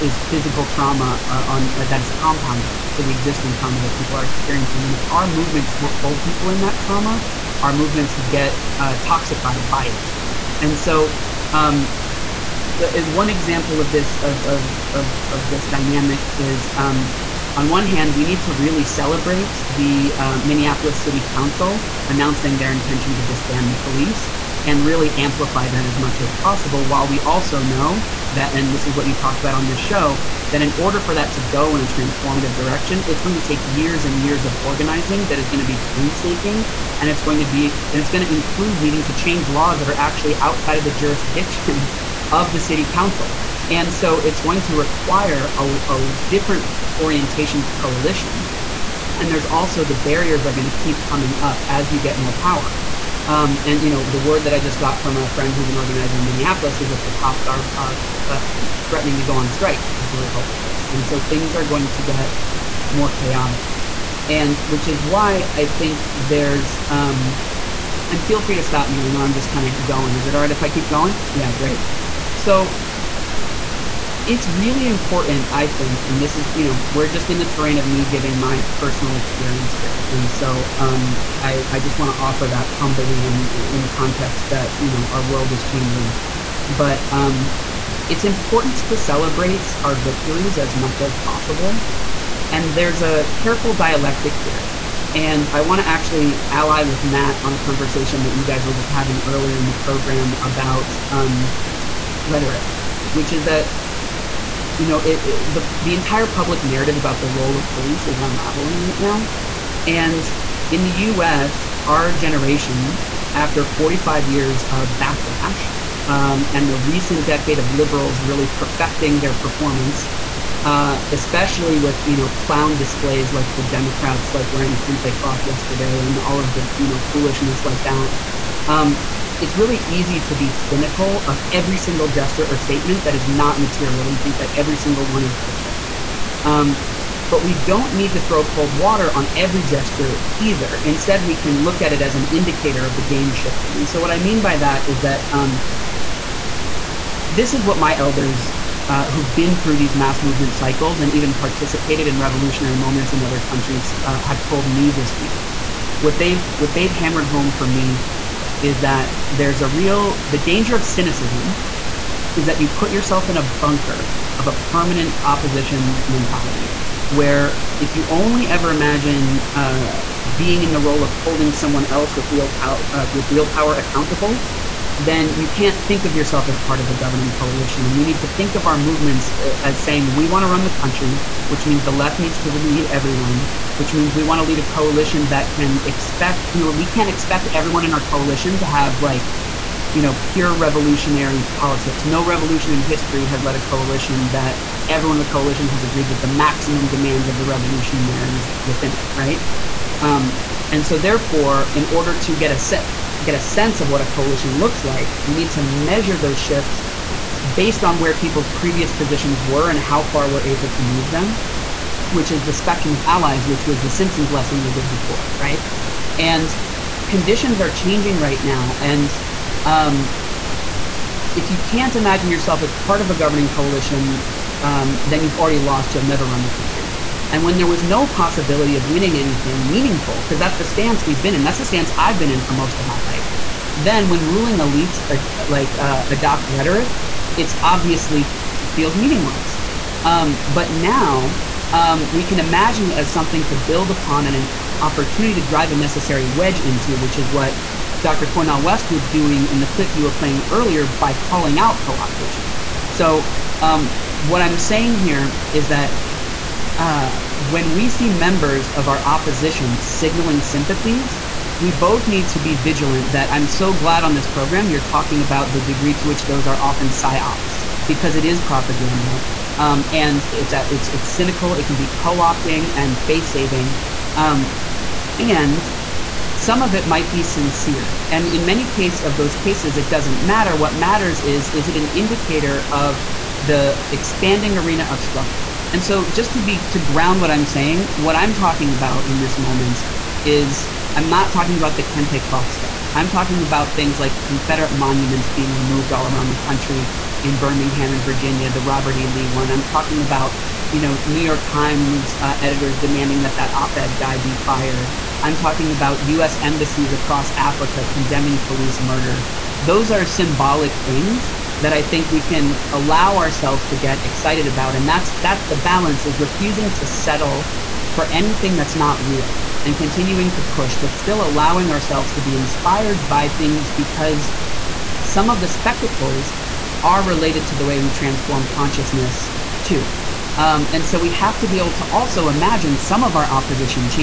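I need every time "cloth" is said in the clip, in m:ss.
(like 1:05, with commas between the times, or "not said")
2:05, 4:52.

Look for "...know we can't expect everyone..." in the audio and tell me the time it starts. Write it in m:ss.
3:06.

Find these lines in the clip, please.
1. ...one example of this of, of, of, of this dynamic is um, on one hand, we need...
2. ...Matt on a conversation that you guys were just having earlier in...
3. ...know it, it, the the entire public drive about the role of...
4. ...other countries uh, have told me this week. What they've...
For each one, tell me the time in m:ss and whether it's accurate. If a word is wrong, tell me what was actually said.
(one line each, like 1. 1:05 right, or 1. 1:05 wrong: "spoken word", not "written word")
1. 0:13 right
2. 1:37 right
3. 1:44 wrong: "narrative", not "drive"
4. 2:33 right.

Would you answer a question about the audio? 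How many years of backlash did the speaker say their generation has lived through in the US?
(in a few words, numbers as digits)
45.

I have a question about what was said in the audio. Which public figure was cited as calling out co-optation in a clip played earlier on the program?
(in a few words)
Cornel West.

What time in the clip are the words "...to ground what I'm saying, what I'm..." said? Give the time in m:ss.
4:46.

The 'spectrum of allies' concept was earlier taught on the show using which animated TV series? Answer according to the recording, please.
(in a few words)
The Simpsons.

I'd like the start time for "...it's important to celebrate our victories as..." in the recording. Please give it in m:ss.
1:28.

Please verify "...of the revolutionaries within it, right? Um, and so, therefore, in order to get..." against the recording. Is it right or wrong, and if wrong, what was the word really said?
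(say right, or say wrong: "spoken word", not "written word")
right.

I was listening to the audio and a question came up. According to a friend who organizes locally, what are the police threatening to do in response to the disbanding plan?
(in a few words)
Go on strike.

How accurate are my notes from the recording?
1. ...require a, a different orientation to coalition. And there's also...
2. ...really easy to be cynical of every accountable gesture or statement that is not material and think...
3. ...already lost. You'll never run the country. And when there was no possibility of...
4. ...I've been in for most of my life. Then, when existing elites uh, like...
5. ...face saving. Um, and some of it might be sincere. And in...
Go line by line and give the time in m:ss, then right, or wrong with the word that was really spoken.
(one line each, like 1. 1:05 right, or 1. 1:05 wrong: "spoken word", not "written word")
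1. 0:44 right
2. 2:09 wrong: "single", not "accountable"
3. 3:45 right
4. 3:51 wrong: "ruling", not "existing"
5. 4:33 right.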